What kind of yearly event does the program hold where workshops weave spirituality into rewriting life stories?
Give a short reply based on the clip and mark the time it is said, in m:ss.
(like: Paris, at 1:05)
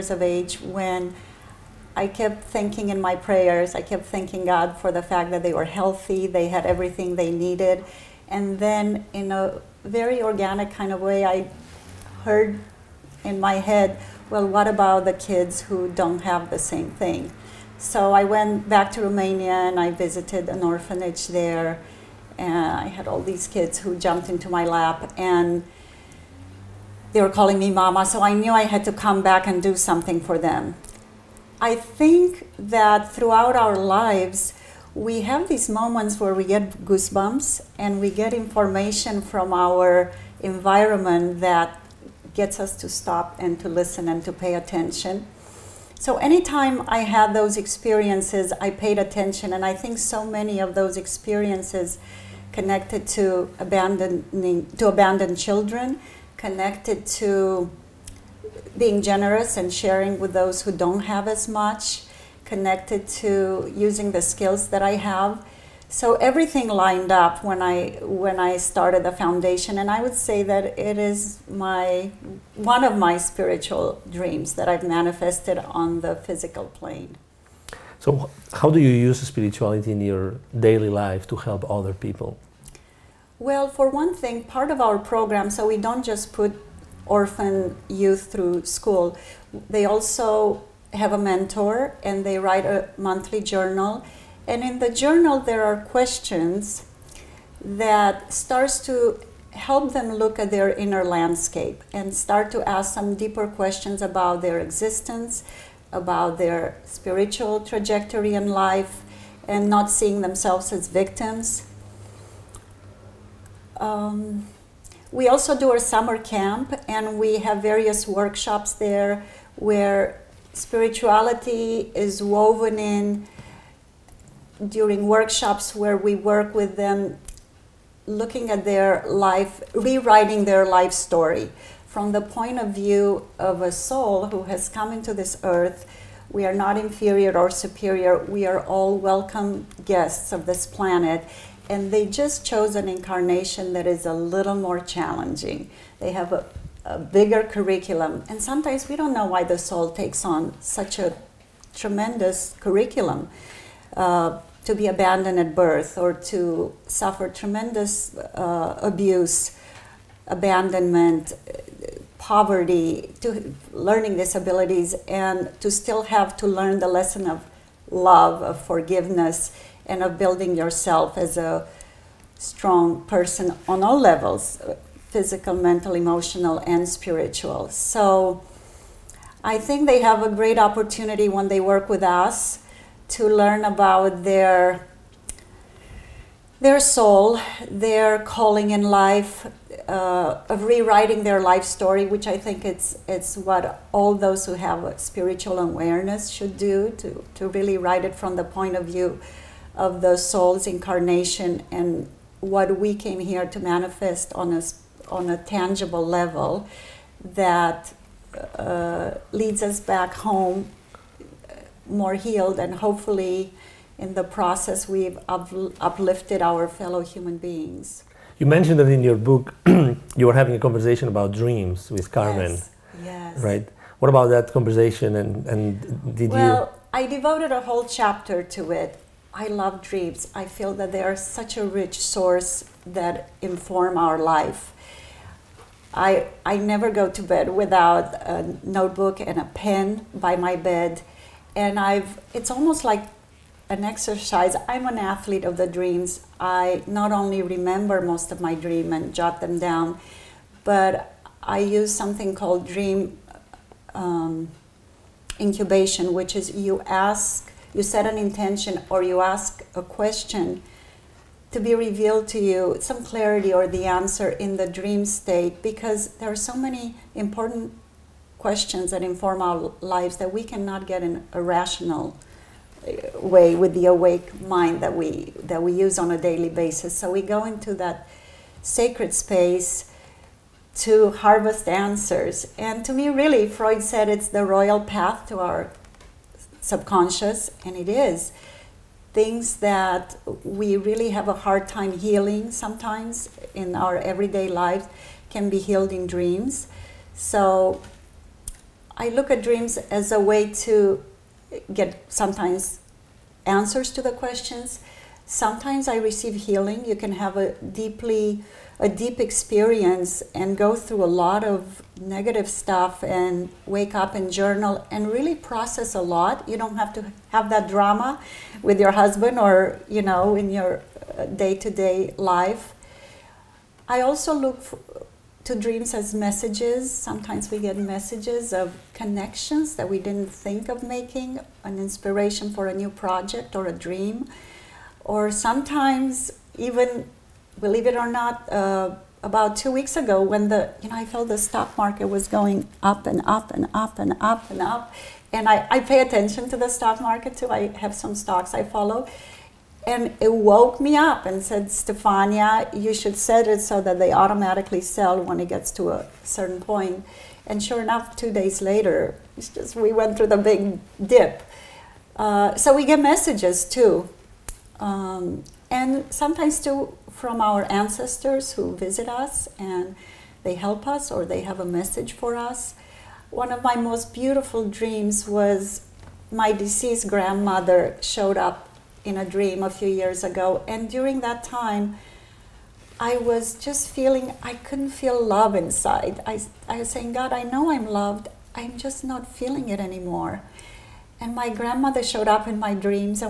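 Summer camp, at 1:55.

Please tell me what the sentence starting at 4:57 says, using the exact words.
So I look at dreams as a way to get sometimes answers to the questions Sometimes I receive healing.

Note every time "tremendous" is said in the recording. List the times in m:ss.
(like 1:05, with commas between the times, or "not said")
2:31, 2:37.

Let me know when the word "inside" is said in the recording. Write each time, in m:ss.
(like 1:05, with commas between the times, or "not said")
6:25.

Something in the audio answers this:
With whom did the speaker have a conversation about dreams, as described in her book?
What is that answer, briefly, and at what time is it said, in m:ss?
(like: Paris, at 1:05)
Carmen, at 3:42.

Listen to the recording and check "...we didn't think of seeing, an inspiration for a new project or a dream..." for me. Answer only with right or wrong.
wrong.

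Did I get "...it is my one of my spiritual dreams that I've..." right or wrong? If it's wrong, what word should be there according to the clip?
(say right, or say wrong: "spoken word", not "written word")
right.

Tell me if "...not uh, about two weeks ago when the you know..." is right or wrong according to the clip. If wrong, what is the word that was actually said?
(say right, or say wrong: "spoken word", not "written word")
right.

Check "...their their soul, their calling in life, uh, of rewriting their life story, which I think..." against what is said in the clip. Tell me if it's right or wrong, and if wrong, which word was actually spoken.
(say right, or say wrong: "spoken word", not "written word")
right.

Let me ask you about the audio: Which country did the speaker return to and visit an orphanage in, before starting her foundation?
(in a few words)
Romania.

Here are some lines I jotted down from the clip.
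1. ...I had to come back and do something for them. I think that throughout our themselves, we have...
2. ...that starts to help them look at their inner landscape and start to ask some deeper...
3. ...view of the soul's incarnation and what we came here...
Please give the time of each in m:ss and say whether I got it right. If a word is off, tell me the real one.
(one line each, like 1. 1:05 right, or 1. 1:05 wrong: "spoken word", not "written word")
1. 0:28 wrong: "lives", not "themselves"
2. 1:37 right
3. 3:18 right.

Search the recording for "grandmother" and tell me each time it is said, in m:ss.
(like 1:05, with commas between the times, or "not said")
6:17, 6:31.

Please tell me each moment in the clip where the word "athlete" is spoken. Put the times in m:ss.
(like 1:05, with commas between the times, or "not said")
4:04.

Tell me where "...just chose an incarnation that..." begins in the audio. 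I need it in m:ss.
2:22.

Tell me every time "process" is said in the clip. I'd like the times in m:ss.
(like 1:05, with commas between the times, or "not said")
3:34, 5:15.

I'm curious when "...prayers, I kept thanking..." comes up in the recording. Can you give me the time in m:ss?
0:03.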